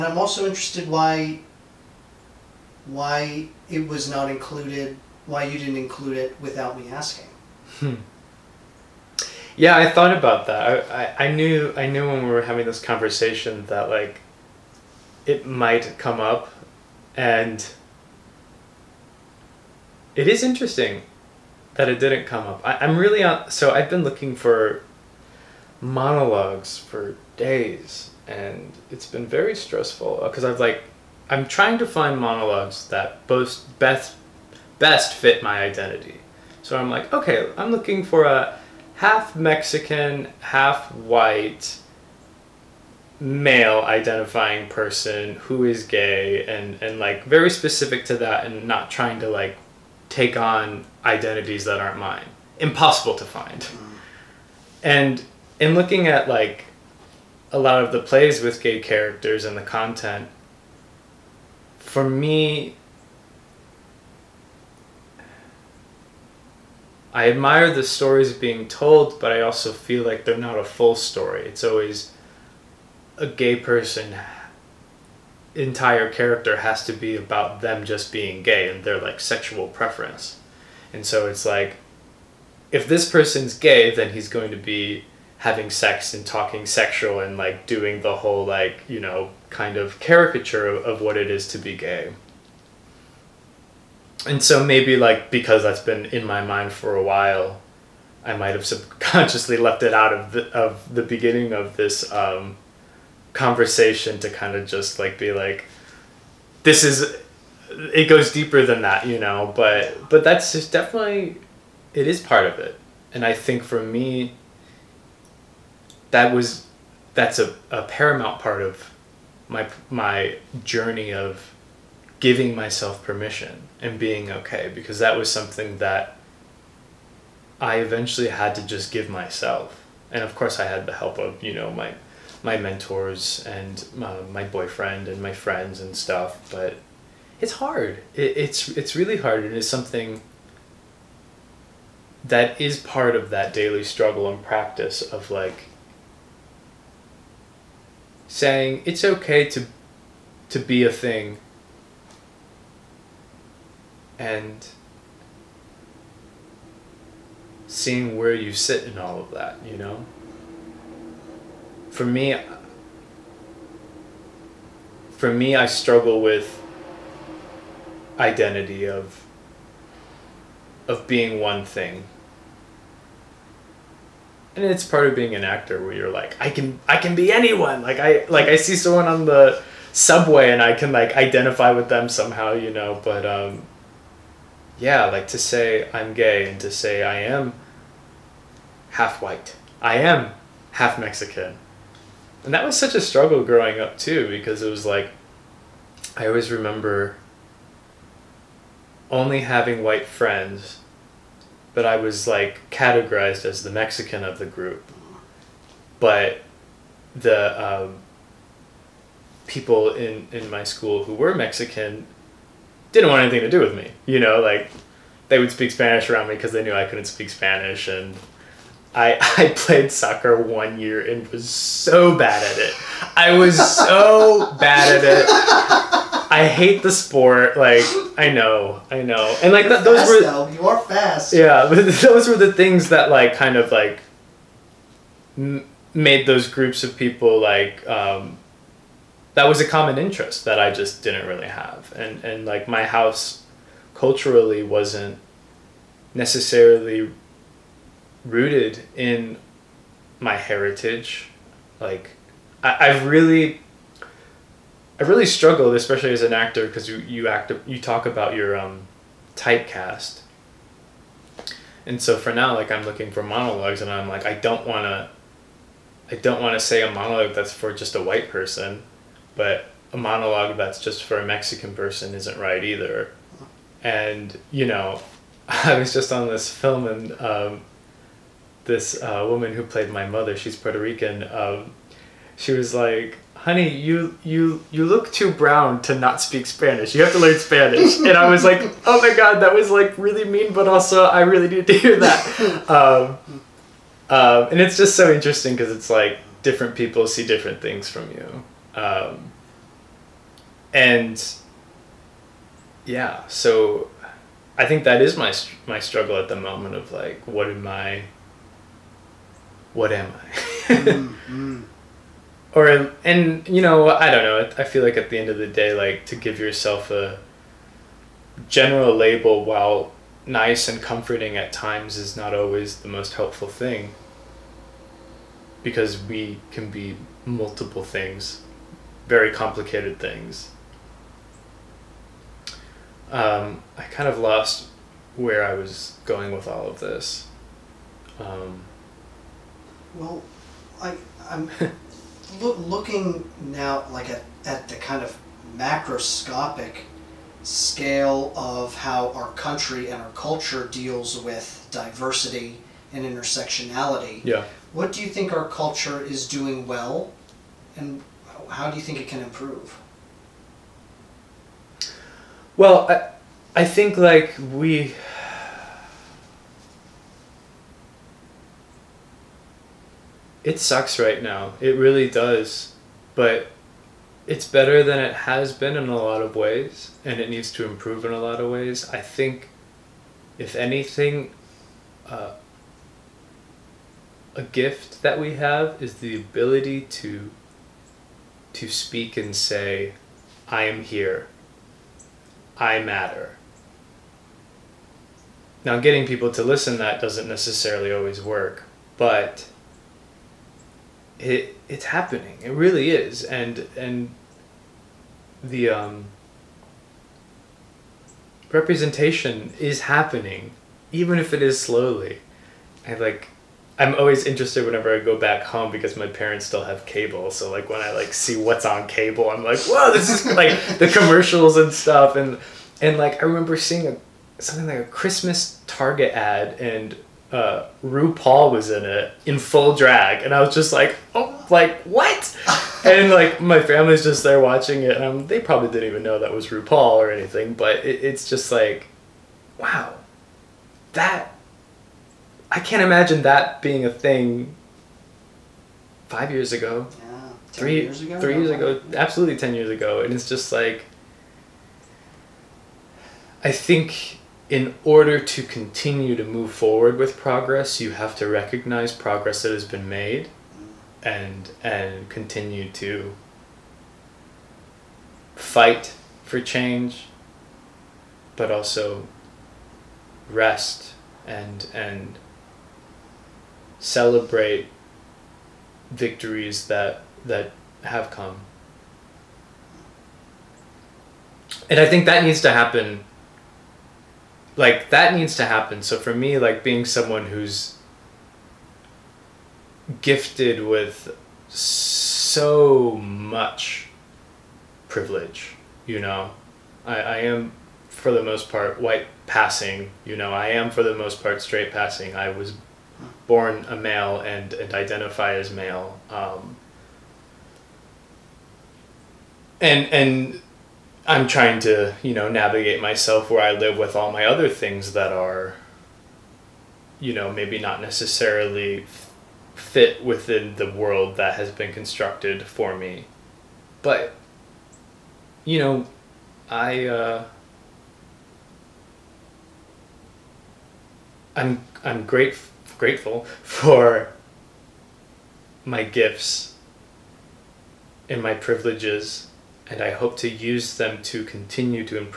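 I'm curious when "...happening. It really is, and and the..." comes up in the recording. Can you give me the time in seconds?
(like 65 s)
401 s.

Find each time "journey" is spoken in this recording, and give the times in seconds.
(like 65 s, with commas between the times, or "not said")
120 s.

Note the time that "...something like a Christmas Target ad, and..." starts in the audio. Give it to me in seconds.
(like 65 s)
424 s.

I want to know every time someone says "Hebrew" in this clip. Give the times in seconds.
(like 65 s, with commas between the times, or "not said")
not said.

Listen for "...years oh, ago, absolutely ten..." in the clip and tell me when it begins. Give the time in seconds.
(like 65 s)
448 s.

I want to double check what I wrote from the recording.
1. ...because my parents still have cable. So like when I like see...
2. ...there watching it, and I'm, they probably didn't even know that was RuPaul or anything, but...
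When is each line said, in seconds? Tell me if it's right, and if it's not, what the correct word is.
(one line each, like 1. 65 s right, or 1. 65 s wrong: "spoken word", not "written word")
1. 415 s right
2. 434 s right.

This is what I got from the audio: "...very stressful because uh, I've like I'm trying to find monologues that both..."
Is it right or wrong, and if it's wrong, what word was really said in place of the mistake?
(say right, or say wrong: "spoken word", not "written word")
right.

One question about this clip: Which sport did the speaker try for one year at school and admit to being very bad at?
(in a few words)
Soccer.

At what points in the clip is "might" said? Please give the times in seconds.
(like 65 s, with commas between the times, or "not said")
15 s, 98 s.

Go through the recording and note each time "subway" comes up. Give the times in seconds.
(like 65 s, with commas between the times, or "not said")
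179 s.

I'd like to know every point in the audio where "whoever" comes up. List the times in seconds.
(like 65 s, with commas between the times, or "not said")
not said.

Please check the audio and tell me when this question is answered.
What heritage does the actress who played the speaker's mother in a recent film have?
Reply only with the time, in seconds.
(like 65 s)
280 s.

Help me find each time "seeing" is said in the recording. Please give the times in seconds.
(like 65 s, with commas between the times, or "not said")
157 s, 423 s.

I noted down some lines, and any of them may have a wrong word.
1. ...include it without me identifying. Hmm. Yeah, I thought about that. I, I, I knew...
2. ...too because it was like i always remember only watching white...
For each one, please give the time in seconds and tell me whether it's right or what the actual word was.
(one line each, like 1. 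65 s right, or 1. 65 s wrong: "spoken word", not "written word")
1. 5 s wrong: "asking", not "identifying"
2. 193 s wrong: "having", not "watching".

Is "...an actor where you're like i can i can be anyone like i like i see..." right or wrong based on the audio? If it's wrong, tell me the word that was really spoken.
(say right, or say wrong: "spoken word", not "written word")
right.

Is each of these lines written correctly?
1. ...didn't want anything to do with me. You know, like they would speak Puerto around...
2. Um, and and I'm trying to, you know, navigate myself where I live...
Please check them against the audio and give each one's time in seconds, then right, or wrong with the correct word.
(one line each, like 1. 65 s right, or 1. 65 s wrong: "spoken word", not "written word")
1. 212 s wrong: "Spanish", not "Puerto"
2. 506 s right.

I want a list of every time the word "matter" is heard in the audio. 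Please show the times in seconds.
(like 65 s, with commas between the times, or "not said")
392 s.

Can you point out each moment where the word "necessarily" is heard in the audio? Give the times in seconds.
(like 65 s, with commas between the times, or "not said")
246 s, 397 s, 517 s.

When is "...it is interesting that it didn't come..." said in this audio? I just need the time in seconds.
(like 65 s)
20 s.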